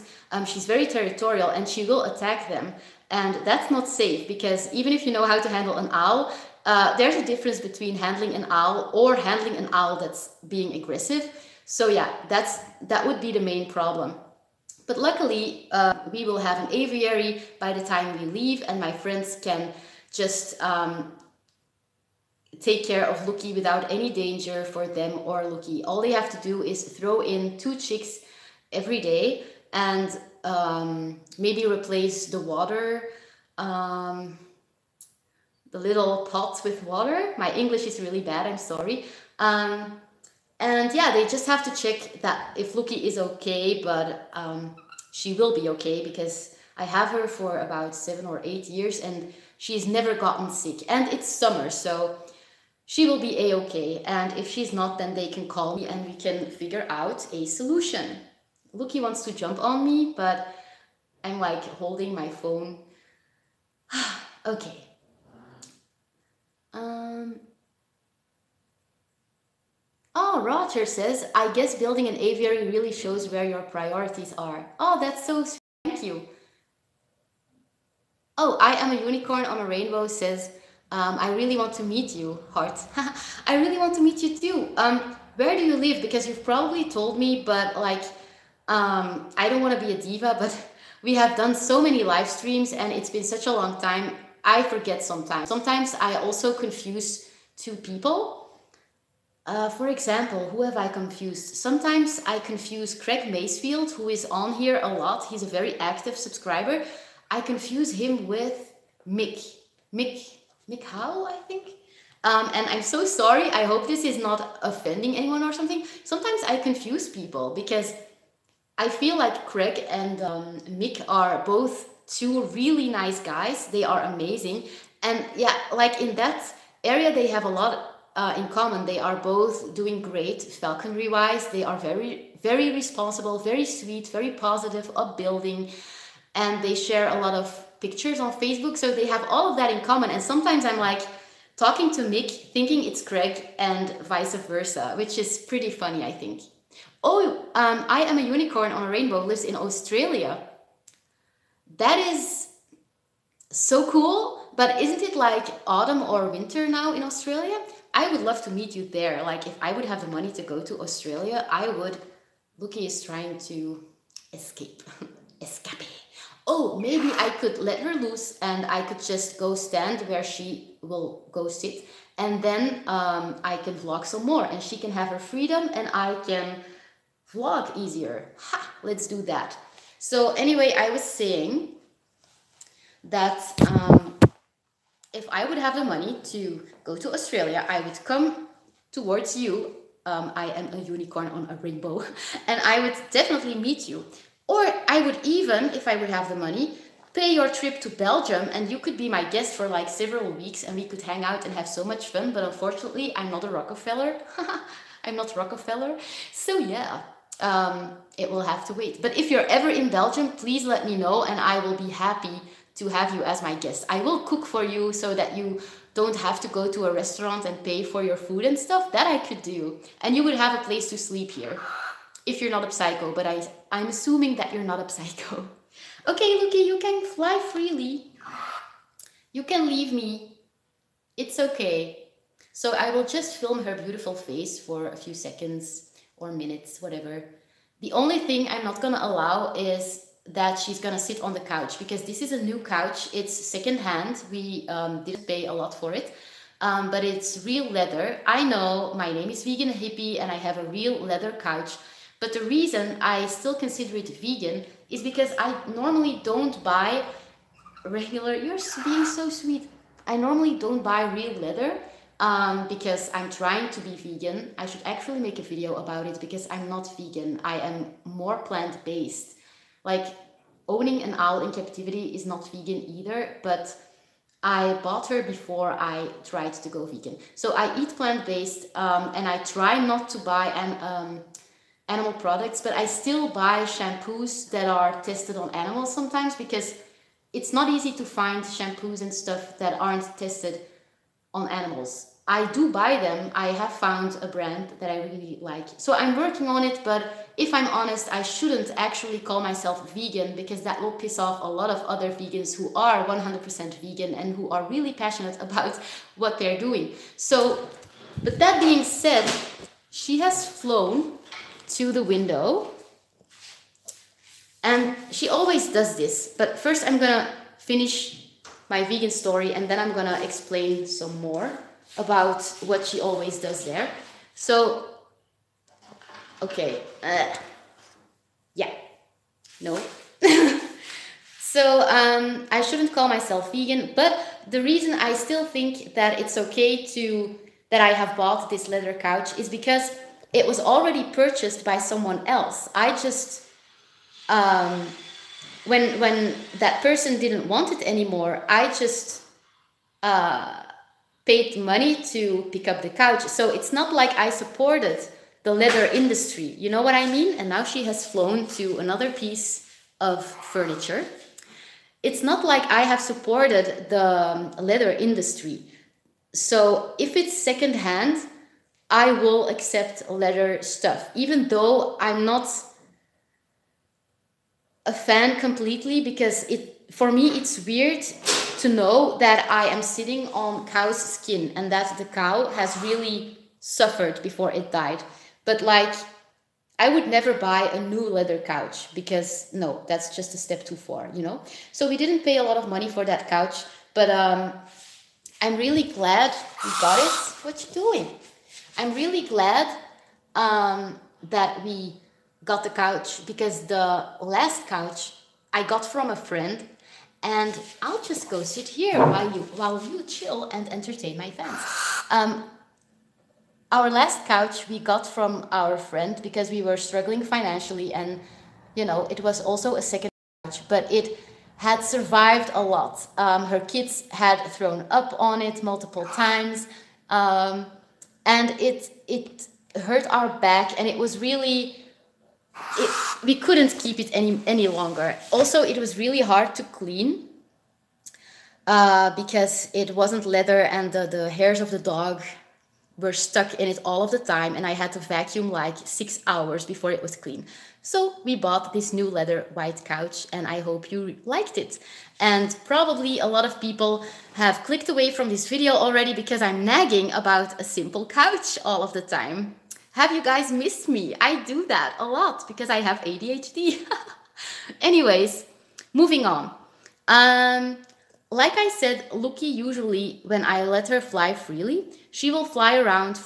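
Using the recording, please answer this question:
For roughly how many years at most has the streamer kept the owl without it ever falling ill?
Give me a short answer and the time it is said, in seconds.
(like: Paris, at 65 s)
8, at 48 s.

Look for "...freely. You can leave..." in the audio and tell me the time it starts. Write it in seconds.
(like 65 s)
227 s.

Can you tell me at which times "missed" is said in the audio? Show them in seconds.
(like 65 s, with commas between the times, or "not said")
460 s.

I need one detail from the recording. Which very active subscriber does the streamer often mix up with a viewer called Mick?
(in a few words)
Craig Macefield.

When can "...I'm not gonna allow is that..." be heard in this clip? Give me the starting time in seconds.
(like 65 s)
238 s.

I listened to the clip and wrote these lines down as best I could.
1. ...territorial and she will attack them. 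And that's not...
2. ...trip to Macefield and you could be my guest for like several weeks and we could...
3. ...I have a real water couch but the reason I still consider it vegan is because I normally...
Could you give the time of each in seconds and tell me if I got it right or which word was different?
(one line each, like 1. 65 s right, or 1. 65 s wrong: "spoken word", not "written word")
1. 0 s right
2. 197 s wrong: "Belgium", not "Macefield"
3. 250 s wrong: "leather", not "water".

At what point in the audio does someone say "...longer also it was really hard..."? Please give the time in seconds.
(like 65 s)
434 s.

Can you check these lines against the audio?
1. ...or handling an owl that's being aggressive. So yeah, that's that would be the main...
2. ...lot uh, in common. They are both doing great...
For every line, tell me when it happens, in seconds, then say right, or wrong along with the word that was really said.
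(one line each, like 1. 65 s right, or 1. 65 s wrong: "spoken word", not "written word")
1. 8 s right
2. 127 s right.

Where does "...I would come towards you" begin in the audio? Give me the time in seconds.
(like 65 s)
187 s.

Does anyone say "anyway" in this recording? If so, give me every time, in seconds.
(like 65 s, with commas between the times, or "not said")
180 s, 464 s.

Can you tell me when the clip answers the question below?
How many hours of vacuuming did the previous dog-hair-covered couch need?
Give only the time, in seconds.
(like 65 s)
445 s.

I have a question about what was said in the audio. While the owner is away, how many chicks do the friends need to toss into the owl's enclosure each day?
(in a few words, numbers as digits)
2.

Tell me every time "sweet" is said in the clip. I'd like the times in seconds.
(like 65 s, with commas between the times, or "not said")
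75 s, 133 s, 259 s.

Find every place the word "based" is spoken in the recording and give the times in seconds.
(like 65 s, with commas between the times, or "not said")
268 s, 278 s.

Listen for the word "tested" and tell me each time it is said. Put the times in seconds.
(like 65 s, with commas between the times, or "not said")
285 s, 290 s.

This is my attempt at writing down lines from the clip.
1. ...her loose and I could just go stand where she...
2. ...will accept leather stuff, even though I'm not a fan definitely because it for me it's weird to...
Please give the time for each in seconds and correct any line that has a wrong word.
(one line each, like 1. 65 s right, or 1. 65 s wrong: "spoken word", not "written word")
1. 167 s right
2. 369 s wrong: "completely", not "definitely".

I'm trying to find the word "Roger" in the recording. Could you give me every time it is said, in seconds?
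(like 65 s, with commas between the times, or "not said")
70 s.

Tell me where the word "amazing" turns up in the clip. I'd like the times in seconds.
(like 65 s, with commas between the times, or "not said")
124 s.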